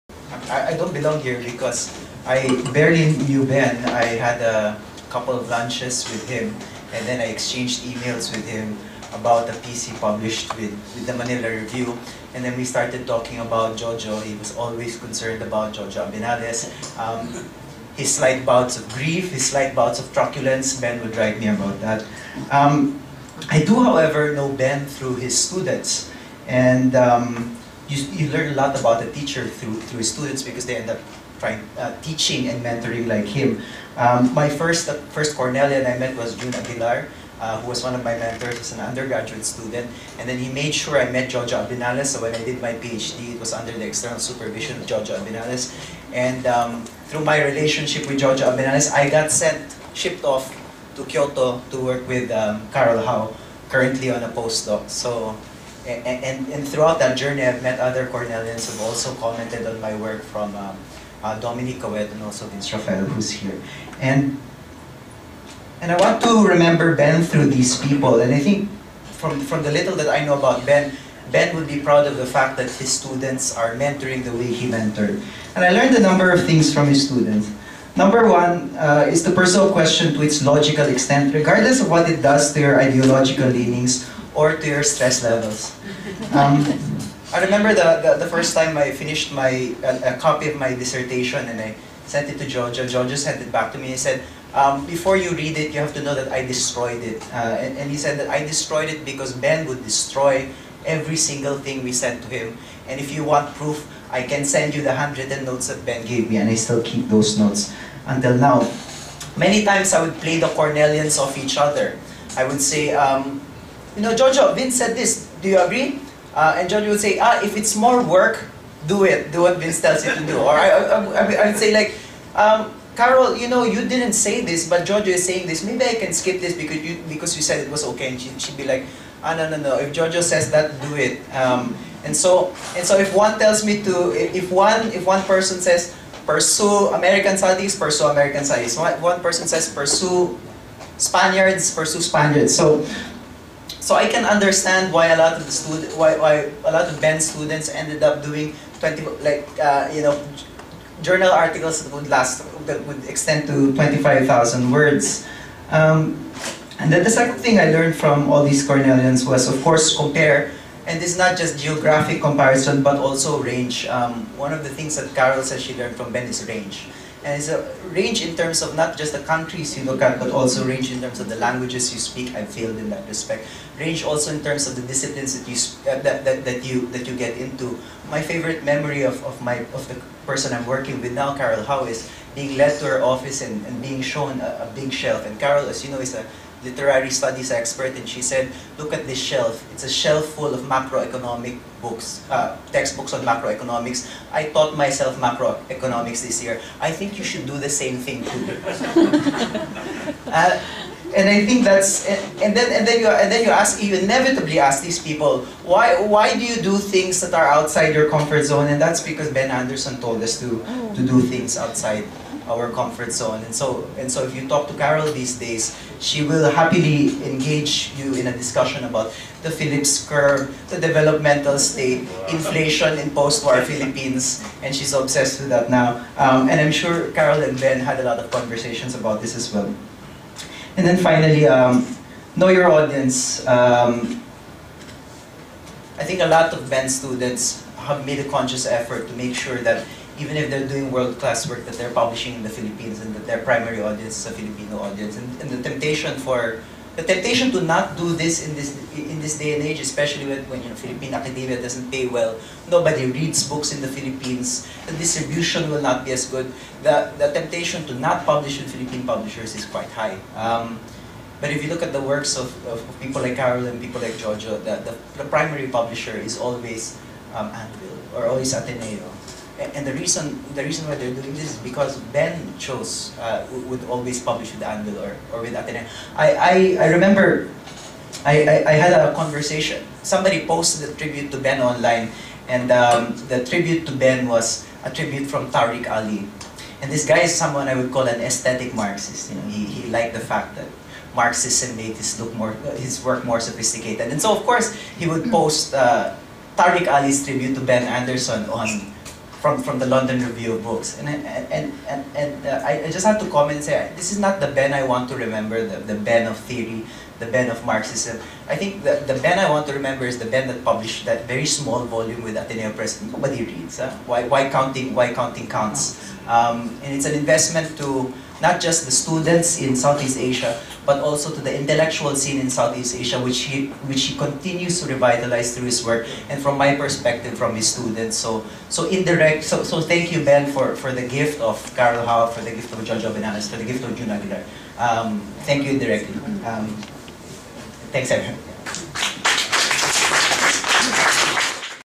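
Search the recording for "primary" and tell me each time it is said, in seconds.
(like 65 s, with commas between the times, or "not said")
243 s, 265 s.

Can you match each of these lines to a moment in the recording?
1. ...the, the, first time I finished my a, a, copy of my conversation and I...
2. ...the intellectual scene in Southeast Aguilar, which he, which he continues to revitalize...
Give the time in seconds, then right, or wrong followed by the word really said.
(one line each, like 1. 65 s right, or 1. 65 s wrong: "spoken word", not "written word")
1. 88 s wrong: "dissertation", not "conversation"
2. 321 s wrong: "Asia", not "Aguilar".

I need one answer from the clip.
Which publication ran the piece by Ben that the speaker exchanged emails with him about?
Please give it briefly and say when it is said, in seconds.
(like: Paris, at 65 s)
Manila Review, at 11 s.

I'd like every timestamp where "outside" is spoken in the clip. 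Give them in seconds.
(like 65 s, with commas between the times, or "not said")
207 s, 211 s.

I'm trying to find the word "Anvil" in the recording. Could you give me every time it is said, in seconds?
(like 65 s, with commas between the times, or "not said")
267 s, 274 s.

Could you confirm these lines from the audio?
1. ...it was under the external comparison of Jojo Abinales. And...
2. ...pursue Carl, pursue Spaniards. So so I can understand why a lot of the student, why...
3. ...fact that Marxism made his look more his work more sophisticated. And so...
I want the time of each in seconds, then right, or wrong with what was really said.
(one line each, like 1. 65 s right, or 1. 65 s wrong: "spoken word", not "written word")
1. 43 s wrong: "supervision", not "comparison"
2. 139 s wrong: "Spaniards", not "Carl"
3. 290 s right.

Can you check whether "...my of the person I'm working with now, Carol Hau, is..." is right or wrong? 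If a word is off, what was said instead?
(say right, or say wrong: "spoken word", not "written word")
right.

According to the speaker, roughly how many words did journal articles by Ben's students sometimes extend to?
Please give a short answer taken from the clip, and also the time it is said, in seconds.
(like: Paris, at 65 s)
25,000, at 153 s.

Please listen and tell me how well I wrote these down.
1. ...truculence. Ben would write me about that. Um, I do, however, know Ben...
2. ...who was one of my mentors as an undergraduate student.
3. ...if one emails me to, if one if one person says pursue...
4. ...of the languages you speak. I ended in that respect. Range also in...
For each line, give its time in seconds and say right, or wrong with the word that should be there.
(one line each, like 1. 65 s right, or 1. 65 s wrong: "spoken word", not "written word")
1. 20 s right
2. 37 s right
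3. 132 s wrong: "tells", not "emails"
4. 171 s wrong: "failed", not "ended".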